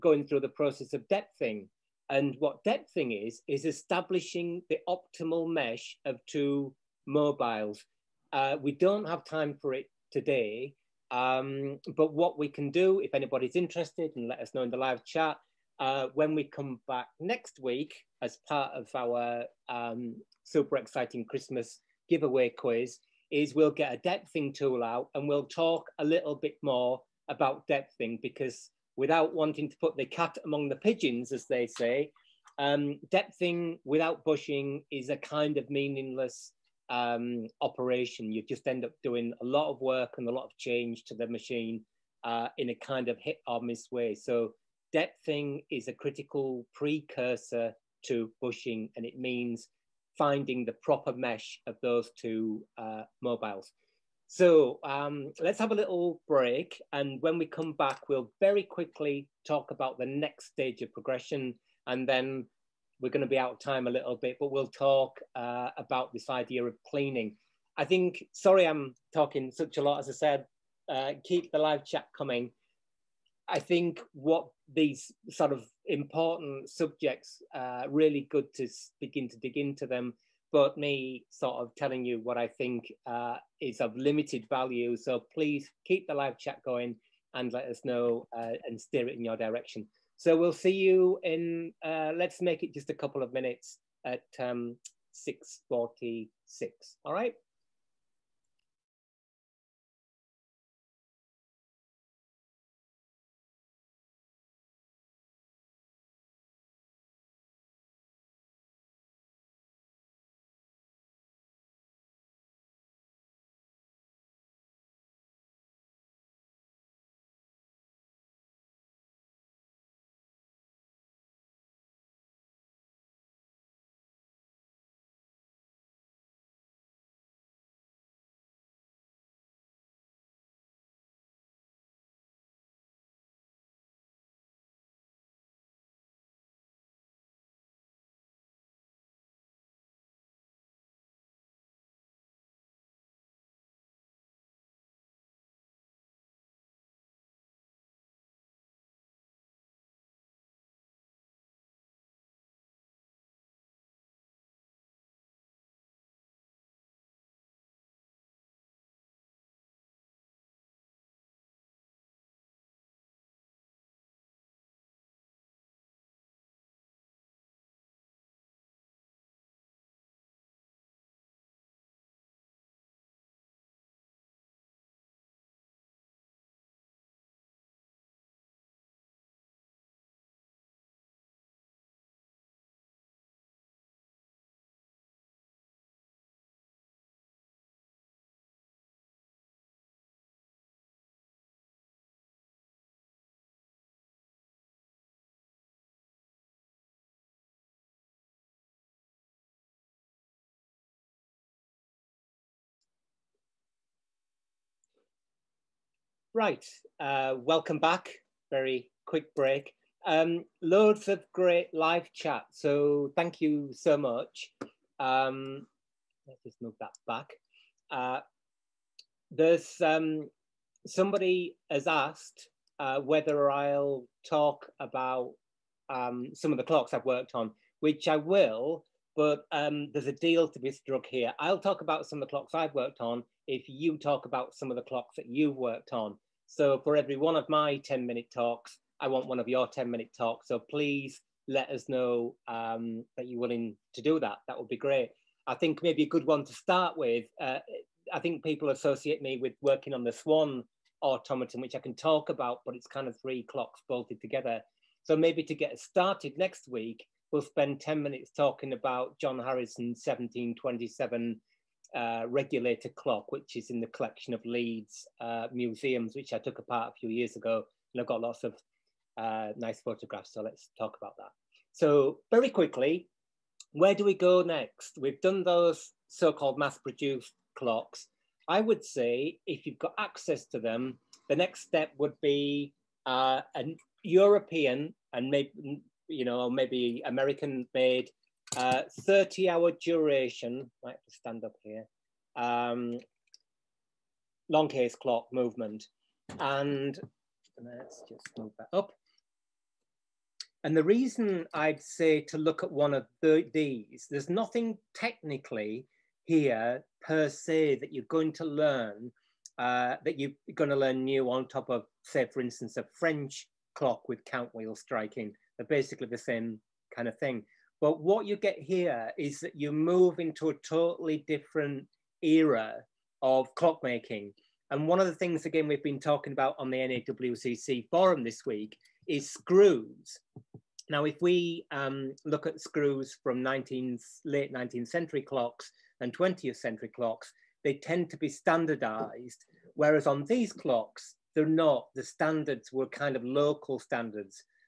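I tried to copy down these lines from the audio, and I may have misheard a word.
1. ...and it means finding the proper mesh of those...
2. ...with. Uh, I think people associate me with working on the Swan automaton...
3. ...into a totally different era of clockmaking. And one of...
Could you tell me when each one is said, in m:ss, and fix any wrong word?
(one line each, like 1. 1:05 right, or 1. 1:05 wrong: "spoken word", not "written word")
1. 0:48 right
2. 4:06 right
3. 5:20 right.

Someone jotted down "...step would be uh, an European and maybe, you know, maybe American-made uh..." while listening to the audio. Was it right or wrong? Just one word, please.
right.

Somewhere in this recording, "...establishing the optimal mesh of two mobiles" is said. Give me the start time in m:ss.
0:03.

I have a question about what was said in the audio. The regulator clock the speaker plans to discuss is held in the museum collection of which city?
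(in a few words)
Leeds.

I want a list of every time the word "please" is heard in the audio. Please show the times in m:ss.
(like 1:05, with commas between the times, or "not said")
1:25, 4:00.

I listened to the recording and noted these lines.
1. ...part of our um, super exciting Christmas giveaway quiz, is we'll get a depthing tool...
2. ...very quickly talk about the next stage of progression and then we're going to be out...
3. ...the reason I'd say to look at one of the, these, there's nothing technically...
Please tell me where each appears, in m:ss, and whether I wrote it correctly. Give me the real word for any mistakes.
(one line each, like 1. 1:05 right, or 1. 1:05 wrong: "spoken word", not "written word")
1. 0:18 right
2. 0:58 right
3. 5:00 right.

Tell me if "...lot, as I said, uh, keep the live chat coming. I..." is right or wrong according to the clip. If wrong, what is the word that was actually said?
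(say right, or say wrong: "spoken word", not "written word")
right.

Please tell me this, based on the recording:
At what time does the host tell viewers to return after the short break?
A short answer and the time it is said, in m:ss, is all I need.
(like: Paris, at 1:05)
6.46, at 1:35.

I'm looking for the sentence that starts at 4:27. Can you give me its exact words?
And I've got lots of uh, nice photographs, so let's talk about that.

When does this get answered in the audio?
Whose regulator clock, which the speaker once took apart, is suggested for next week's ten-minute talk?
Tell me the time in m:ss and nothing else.
4:19.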